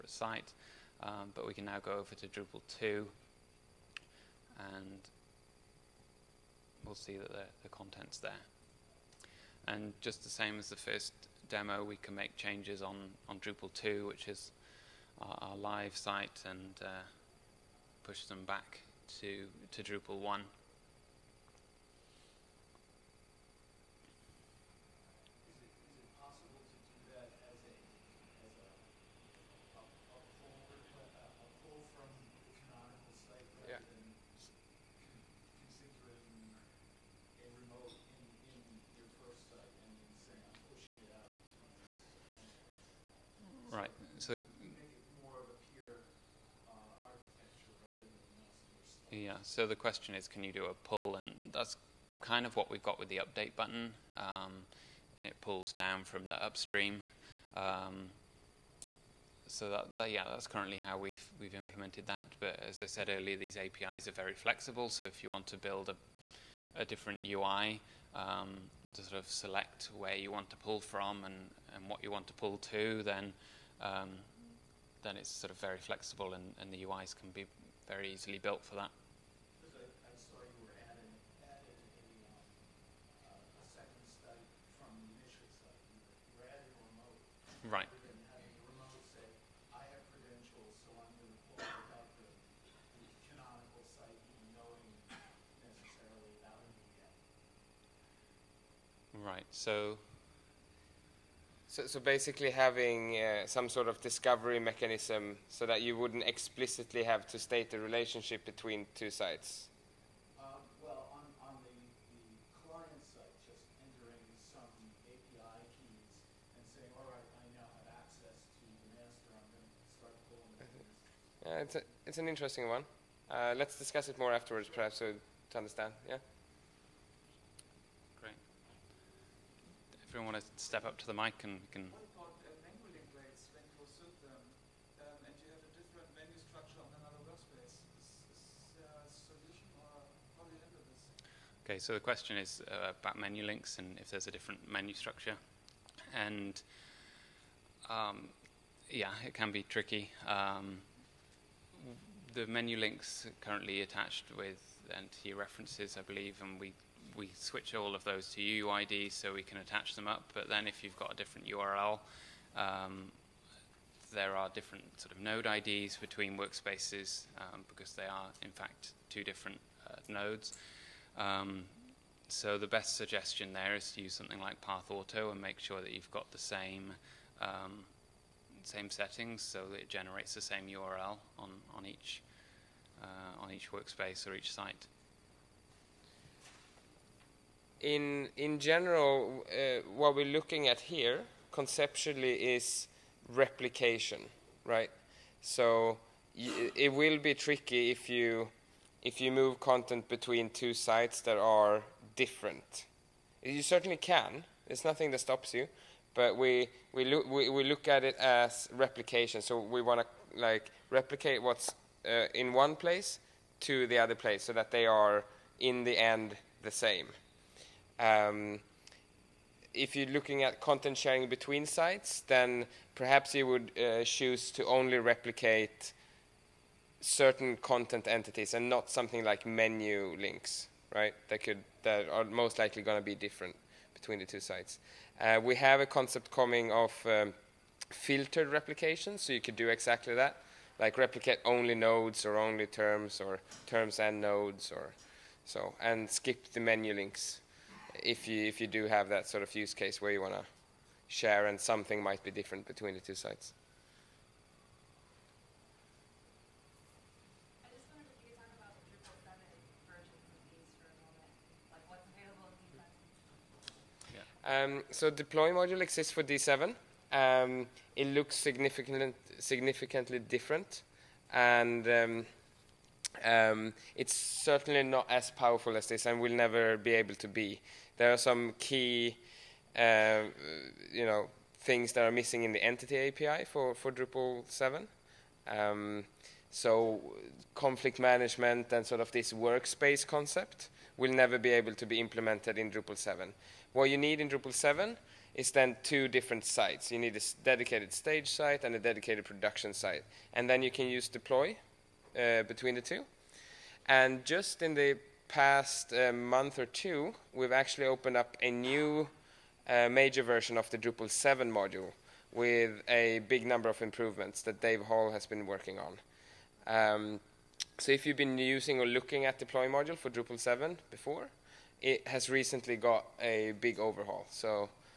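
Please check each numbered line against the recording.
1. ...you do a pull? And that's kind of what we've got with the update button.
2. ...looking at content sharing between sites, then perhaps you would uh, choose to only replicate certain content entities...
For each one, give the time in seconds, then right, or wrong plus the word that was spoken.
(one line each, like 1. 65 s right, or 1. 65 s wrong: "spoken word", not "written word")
1. 50 s right
2. 220 s right.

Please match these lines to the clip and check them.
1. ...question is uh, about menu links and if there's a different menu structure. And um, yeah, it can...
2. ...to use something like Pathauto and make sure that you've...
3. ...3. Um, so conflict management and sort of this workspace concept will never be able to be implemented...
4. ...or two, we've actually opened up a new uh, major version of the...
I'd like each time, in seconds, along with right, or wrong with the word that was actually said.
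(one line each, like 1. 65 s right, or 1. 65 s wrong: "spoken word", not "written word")
1. 141 s right
2. 173 s right
3. 284 s wrong: "7", not "3"
4. 306 s right.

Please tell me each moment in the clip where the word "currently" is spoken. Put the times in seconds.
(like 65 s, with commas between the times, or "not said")
60 s, 153 s.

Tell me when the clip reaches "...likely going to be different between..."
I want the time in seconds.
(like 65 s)
232 s.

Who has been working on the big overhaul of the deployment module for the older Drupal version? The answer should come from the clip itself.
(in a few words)
Dave Hall.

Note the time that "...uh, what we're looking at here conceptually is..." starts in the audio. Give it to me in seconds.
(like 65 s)
189 s.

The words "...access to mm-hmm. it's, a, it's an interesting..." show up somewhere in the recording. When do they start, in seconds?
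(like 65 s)
118 s.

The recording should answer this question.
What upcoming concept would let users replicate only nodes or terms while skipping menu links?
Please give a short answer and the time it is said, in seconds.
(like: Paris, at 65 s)
Filtered replication, at 237 s.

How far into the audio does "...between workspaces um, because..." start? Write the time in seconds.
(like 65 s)
165 s.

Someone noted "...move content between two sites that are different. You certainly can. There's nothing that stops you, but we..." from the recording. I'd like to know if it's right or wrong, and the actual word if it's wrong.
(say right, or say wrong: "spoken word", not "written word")
right.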